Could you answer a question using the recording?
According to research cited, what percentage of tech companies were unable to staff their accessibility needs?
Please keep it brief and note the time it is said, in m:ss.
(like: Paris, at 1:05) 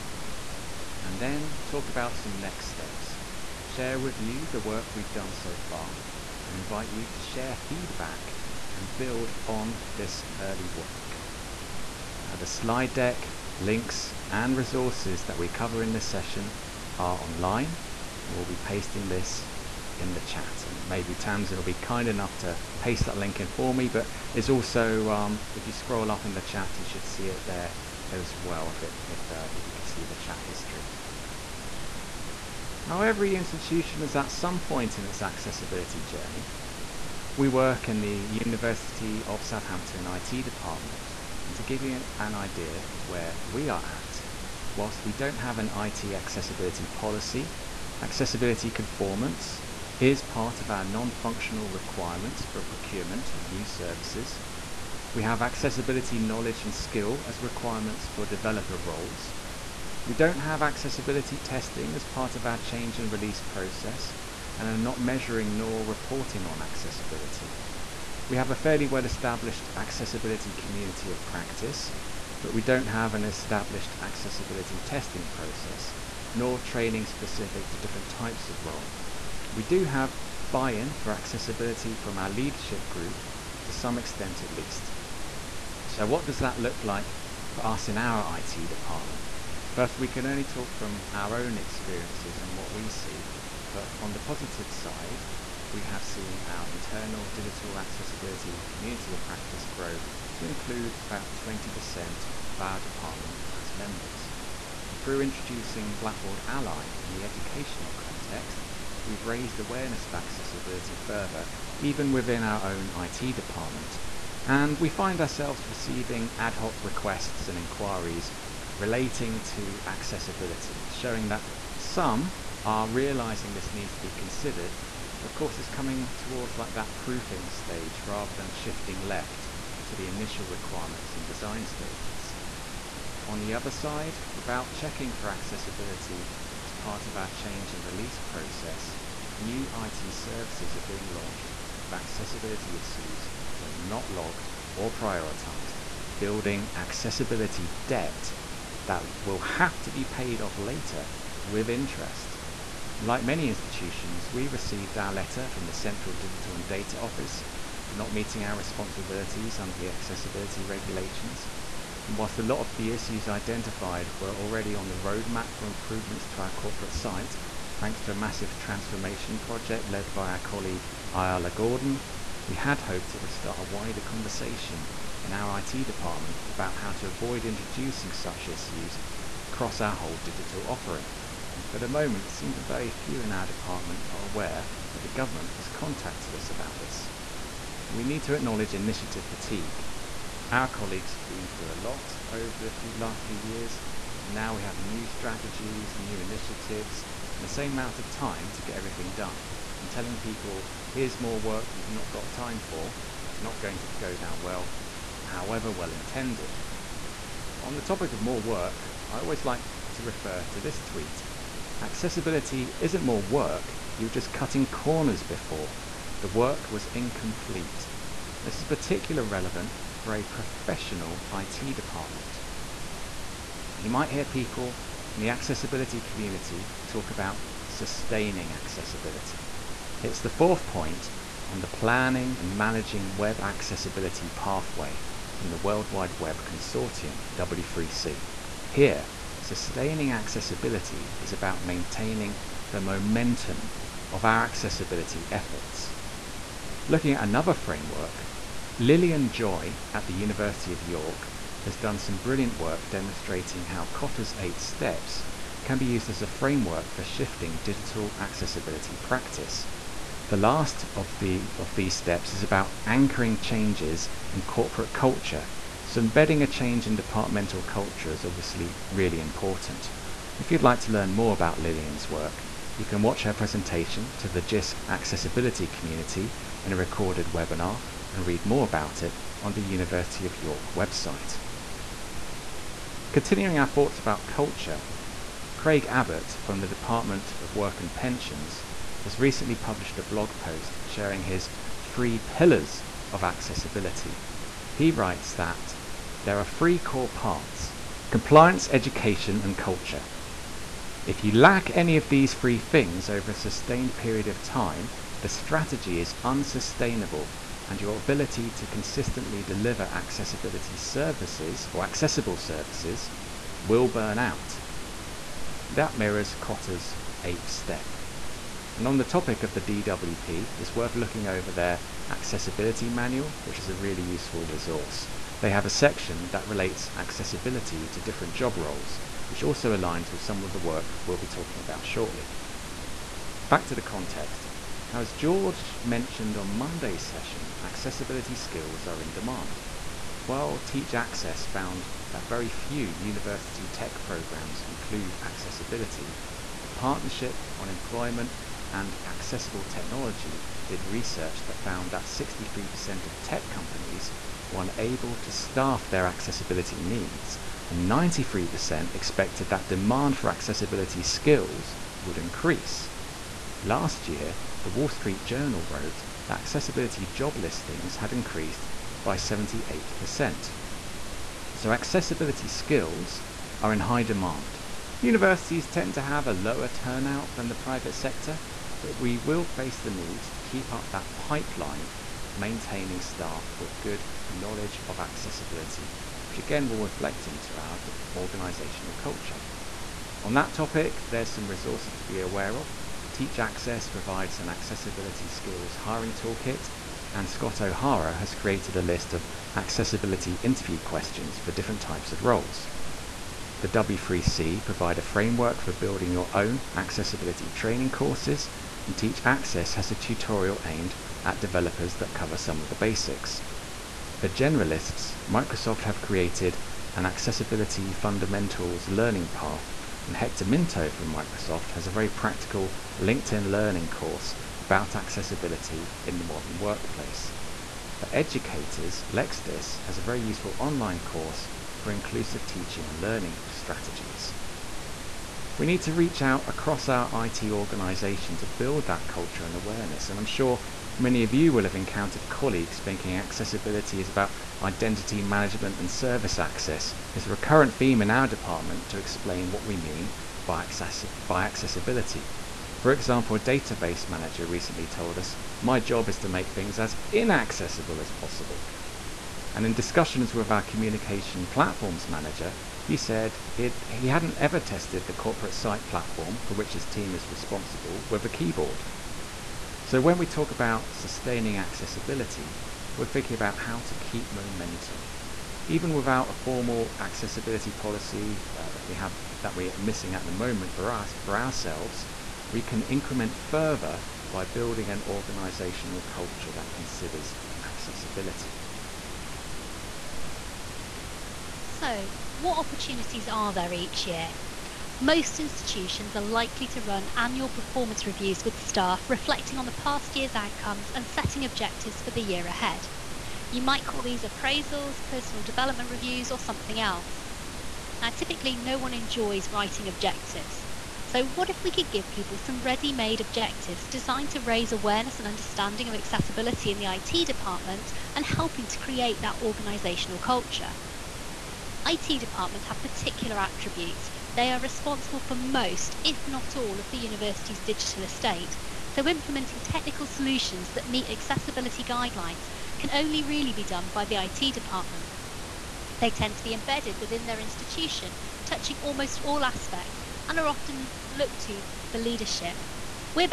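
63%, at 5:52.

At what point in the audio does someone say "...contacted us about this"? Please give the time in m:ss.
3:05.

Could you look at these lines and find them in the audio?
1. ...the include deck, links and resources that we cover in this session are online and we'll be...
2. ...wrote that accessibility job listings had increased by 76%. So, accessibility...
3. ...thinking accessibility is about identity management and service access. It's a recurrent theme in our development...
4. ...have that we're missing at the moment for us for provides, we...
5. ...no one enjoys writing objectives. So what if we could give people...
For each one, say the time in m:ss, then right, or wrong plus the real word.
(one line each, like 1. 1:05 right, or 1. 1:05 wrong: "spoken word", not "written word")
1. 0:12 wrong: "slide", not "include"
2. 6:05 wrong: "78", not "76"
3. 7:22 wrong: "department", not "development"
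4. 7:58 wrong: "ourselves", not "provides"
5. 8:28 right.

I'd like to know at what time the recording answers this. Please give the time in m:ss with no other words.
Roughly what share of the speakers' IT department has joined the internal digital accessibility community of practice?
1:41.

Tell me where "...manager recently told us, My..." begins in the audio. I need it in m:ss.
7:34.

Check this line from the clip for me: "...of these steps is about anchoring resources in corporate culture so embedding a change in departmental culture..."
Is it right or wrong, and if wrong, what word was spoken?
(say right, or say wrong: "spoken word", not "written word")
wrong: "changes", not "resources".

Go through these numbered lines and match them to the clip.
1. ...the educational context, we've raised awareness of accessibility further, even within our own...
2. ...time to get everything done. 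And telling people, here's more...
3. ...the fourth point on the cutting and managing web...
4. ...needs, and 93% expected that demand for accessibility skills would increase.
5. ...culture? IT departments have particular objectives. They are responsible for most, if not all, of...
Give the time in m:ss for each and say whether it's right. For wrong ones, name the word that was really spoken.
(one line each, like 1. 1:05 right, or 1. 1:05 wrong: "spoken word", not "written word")
1. 1:47 right
2. 3:18 right
3. 3:50 wrong: "planning", not "cutting"
4. 5:56 right
5. 8:40 wrong: "attributes", not "objectives".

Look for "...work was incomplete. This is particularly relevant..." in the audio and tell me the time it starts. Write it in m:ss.
3:36.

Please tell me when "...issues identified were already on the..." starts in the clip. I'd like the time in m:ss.
2:42.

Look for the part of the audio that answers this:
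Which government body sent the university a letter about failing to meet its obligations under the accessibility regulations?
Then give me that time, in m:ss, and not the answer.
2:35.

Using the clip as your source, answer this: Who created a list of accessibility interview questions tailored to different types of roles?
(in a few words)
Scott O'Hara.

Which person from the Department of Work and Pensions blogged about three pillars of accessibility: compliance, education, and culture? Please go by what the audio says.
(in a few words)
Craig Abbott.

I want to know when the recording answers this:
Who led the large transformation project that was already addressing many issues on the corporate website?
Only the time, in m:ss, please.
2:51.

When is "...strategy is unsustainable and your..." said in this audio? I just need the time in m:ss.
5:05.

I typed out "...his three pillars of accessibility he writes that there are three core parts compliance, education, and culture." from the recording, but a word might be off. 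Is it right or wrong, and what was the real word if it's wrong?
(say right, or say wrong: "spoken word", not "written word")
right.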